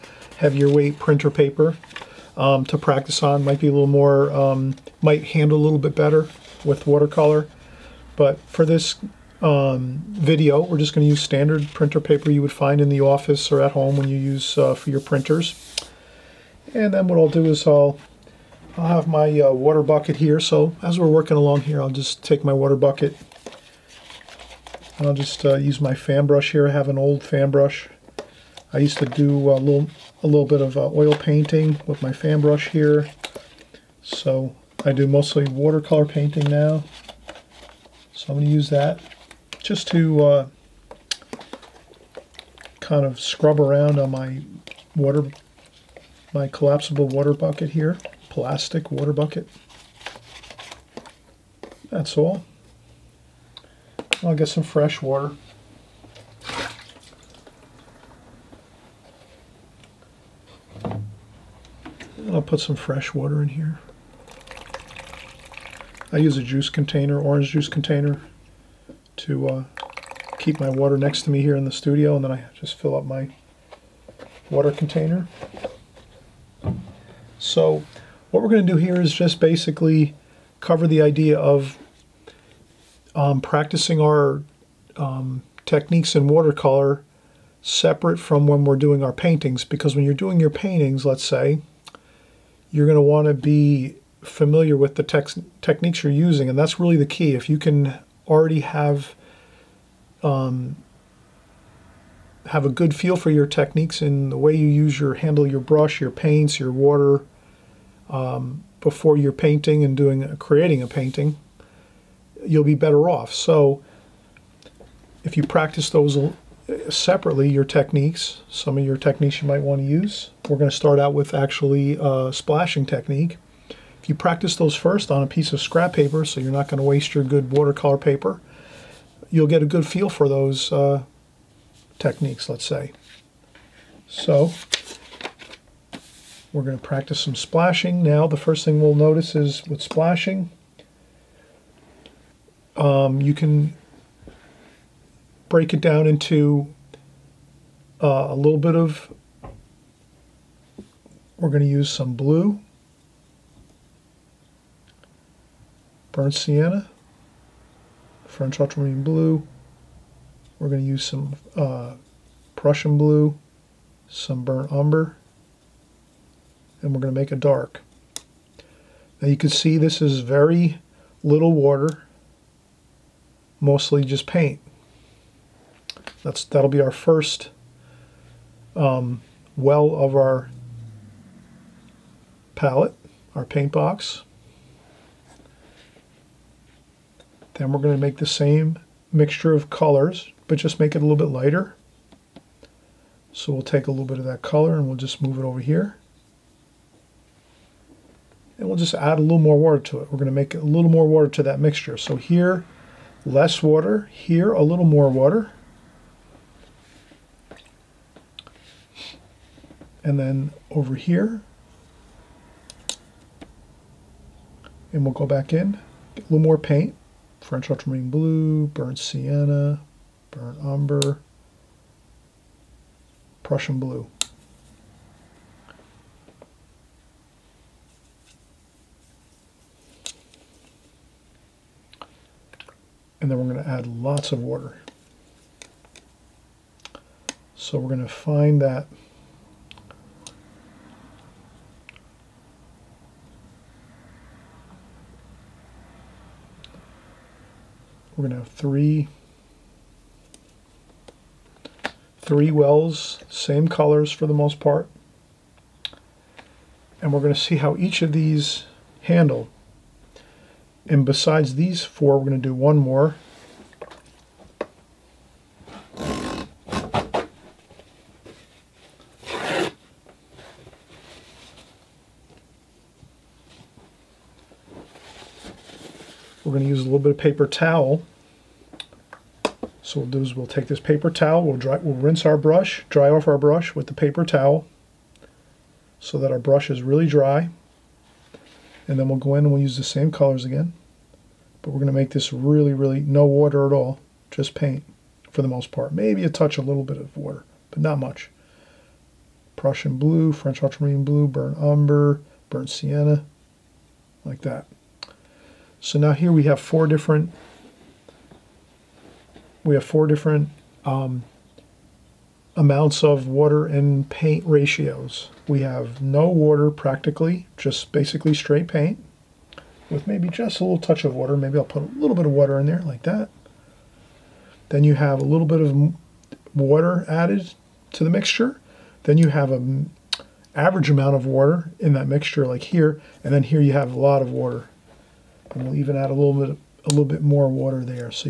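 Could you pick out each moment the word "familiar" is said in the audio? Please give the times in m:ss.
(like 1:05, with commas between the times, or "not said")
1:34.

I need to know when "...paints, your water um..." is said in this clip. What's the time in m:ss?
1:46.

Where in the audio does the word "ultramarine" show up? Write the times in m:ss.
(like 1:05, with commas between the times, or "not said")
2:38, 3:37, 5:00.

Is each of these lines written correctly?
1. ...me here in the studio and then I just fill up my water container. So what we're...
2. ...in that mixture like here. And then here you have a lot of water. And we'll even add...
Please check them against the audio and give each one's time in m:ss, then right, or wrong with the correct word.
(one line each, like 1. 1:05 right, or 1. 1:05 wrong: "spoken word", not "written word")
1. 1:11 right
2. 5:31 right.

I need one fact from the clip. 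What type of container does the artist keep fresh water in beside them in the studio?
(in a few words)
orange juice container.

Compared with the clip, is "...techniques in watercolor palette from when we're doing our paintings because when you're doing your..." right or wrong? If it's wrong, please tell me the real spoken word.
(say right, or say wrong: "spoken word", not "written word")
wrong: "separate", not "palette".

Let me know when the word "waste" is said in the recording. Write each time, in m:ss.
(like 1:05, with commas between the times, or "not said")
2:06.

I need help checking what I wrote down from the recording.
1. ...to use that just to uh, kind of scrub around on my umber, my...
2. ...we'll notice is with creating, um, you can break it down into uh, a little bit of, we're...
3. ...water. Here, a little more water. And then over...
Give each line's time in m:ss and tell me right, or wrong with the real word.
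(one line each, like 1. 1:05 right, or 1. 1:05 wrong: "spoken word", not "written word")
1. 0:38 wrong: "water", not "umber"
2. 2:18 wrong: "splashing", not "creating"
3. 3:23 right.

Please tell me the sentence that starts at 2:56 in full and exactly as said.
That's That'll be our first um, well of our palette, our paint box.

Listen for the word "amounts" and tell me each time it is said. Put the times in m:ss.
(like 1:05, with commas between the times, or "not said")
5:12, 5:30.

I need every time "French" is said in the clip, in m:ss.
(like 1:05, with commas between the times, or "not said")
2:38, 3:37, 5:00.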